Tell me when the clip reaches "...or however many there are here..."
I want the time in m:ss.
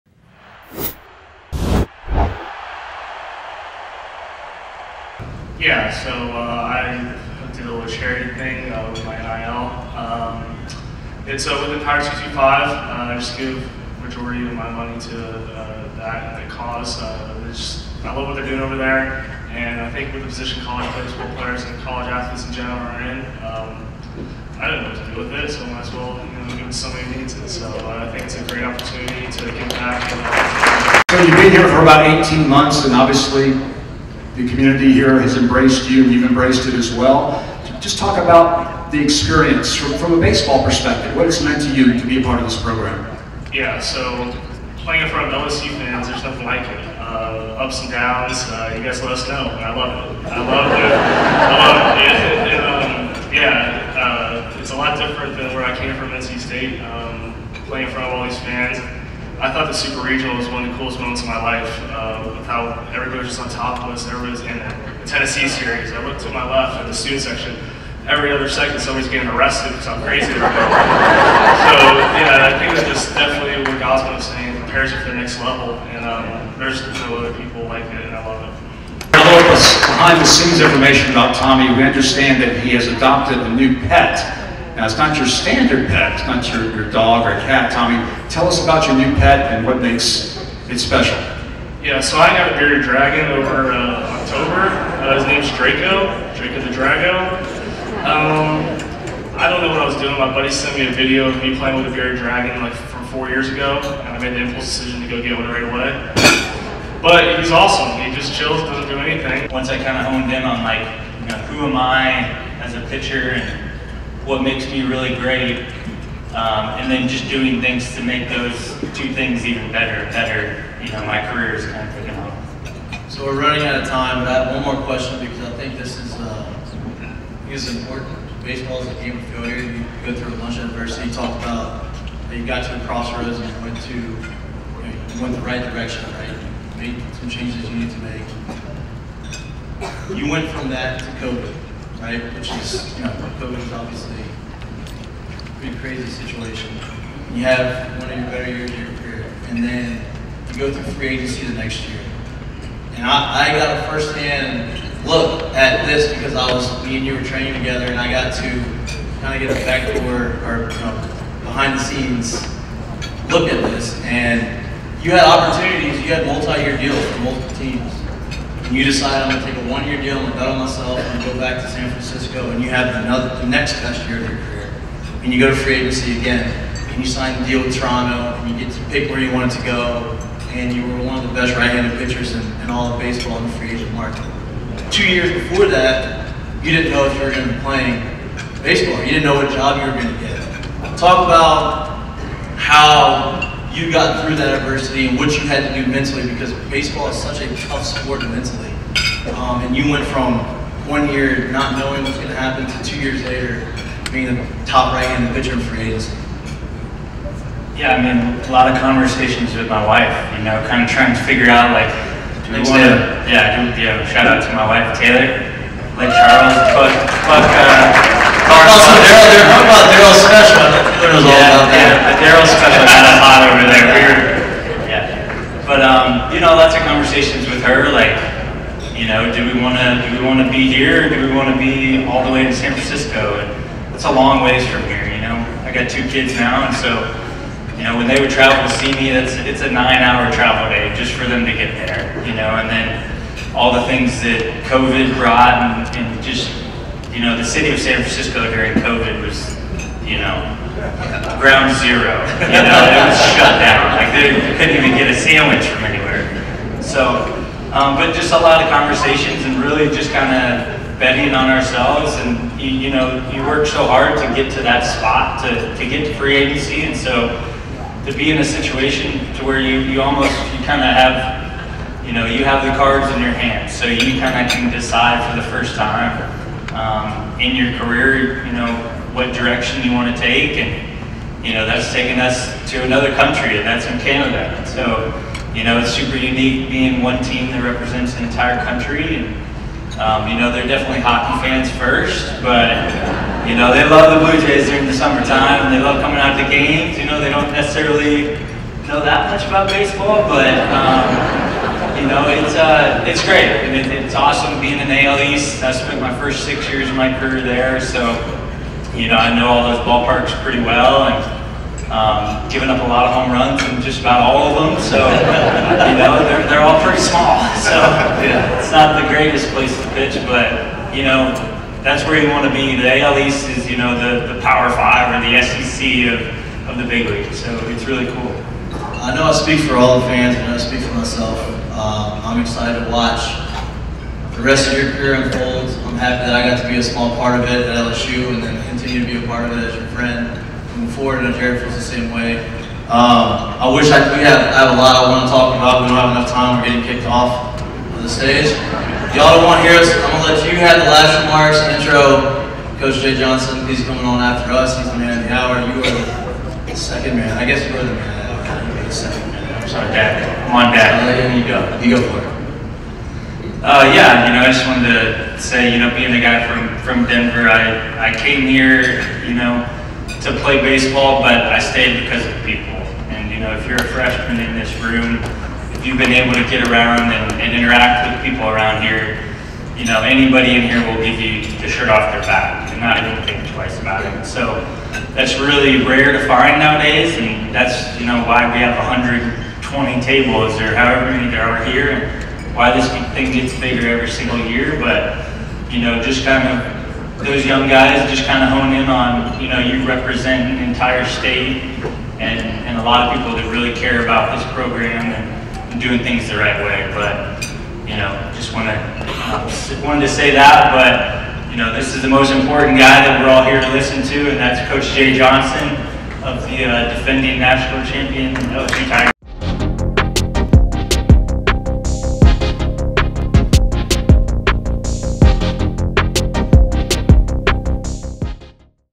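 6:30.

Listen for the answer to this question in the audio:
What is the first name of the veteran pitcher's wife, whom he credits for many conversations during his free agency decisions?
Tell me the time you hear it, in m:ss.
3:34.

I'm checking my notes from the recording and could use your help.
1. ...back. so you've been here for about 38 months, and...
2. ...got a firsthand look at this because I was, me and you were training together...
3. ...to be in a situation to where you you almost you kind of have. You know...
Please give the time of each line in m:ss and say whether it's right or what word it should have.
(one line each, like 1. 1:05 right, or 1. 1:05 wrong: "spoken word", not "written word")
1. 0:29 wrong: "18", not "38"
2. 2:33 right
3. 4:28 right.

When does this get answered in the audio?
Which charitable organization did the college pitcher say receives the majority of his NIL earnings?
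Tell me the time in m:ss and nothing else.
0:11.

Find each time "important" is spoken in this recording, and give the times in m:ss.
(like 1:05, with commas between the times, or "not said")
2:07, 6:52.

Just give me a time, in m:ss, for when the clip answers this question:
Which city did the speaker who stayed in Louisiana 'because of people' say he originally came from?
6:07.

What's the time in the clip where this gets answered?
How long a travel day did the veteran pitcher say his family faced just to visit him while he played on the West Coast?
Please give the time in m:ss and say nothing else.
3:59.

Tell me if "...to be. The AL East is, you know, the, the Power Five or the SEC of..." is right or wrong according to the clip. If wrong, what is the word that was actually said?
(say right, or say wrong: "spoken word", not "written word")
right.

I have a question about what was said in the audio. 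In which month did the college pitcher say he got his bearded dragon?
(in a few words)
October.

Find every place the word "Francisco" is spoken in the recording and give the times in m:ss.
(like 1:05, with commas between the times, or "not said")
2:51, 3:52, 4:08.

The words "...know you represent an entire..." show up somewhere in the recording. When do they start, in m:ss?
6:39.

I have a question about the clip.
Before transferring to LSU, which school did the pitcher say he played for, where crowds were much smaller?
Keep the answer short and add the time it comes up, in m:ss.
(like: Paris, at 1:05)
NC State, at 0:56.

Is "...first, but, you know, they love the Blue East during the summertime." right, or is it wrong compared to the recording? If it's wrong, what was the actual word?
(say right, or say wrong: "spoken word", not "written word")
wrong: "Jays", not "East".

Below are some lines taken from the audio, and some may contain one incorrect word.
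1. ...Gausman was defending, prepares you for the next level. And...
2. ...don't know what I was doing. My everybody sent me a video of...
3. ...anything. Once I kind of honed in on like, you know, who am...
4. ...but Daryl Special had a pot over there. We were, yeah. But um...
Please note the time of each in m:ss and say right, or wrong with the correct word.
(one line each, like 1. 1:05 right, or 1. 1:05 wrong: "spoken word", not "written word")
1. 1:13 wrong: "saying", not "defending"
2. 1:39 wrong: "buddy", not "everybody"
3. 1:48 right
4. 3:42 right.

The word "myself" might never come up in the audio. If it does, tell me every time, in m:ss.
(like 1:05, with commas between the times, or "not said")
2:50, 5:30.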